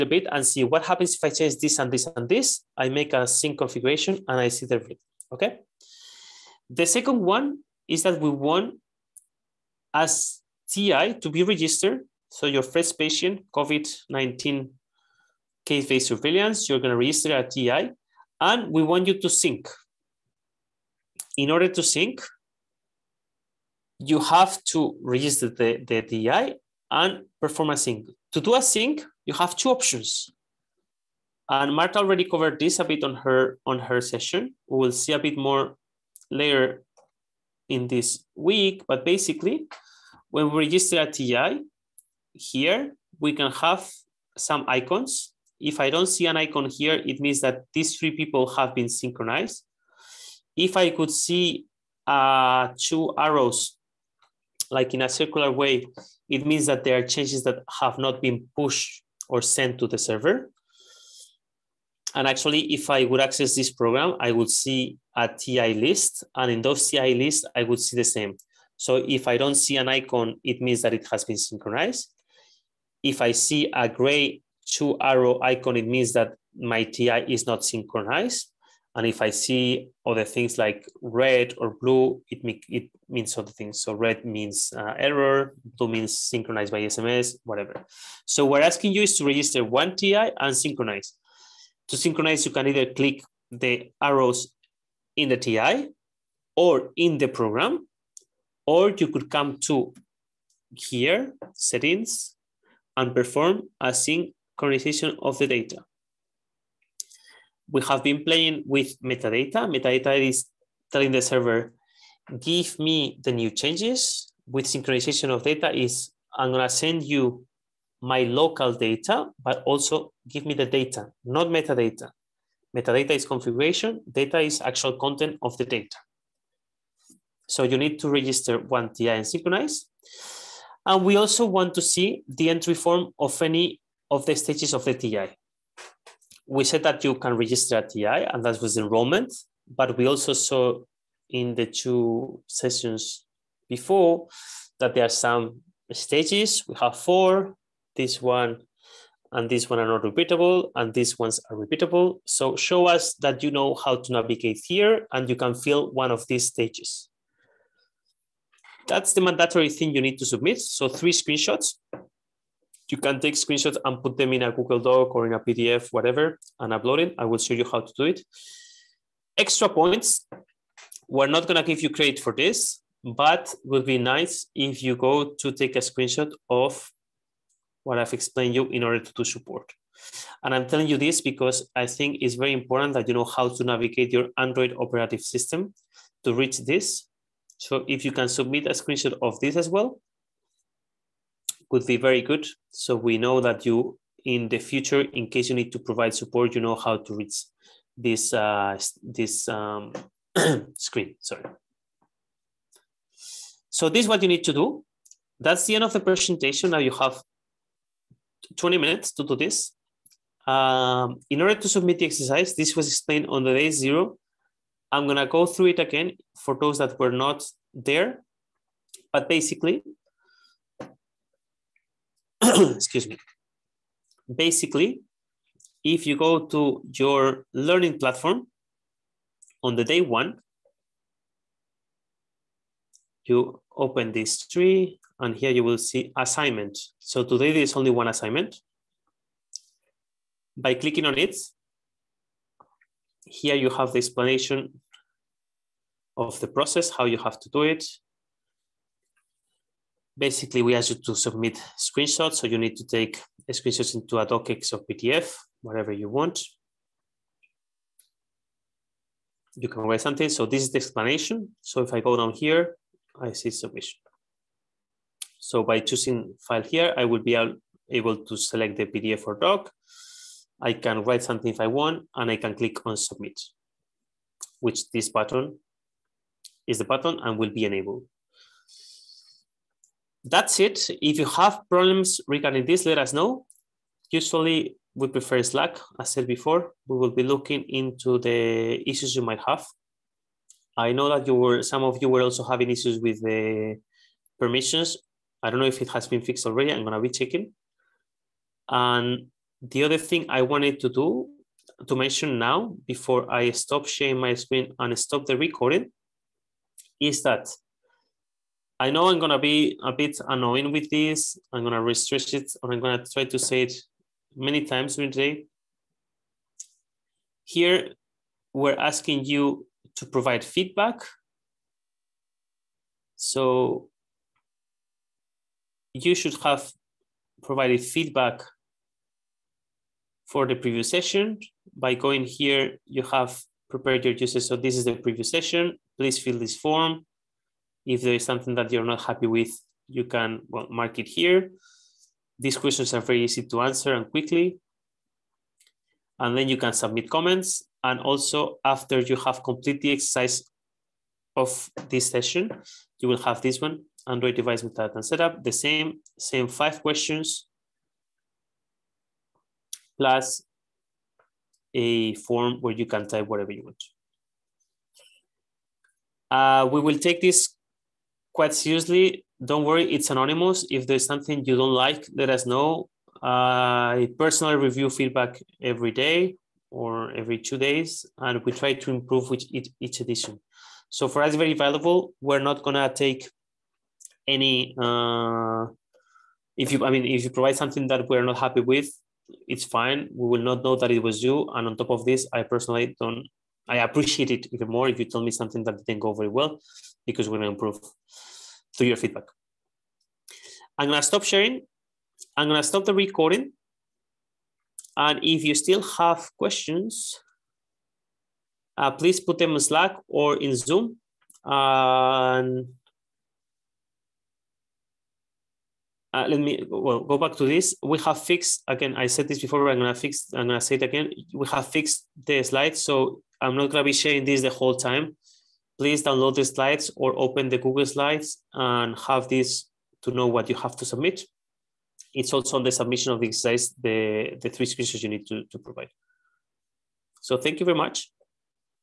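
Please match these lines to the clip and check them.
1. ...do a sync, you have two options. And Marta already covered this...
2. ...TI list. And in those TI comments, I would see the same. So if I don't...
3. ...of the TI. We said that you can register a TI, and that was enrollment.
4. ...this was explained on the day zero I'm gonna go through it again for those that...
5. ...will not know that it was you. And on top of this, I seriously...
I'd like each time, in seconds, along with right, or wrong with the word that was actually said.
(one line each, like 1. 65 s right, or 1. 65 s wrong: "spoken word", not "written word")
1. 28 s right
2. 65 s wrong: "lists", not "comments"
3. 134 s right
4. 212 s right
5. 390 s wrong: "personally", not "seriously".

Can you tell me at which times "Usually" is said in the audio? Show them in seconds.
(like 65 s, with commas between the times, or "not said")
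284 s.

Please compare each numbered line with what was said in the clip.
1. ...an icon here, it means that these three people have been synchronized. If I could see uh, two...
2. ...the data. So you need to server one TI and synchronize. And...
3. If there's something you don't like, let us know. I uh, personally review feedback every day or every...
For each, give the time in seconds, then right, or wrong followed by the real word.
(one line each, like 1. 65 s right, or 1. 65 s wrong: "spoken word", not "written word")
1. 46 s right
2. 125 s wrong: "register", not "server"
3. 370 s right.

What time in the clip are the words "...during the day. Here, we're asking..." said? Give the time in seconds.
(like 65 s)
314 s.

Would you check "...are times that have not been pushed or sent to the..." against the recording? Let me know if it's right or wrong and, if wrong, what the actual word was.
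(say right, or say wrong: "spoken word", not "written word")
wrong: "changes", not "times".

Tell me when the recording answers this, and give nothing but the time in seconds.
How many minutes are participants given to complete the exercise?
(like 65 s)
208 s.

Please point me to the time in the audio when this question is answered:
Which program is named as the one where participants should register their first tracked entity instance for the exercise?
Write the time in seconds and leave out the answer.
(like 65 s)
13 s.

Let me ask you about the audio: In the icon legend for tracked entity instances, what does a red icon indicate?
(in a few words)
Error.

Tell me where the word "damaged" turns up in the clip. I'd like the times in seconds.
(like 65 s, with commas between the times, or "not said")
not said.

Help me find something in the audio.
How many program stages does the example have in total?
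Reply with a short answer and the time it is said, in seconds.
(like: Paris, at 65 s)
4, at 146 s.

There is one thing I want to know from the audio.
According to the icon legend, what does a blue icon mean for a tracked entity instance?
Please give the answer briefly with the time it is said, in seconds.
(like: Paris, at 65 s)
Synchronized by SMS, at 86 s.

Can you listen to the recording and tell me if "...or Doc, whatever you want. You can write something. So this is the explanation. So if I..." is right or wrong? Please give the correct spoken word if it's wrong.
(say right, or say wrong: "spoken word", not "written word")
wrong: "PDF", not "Doc".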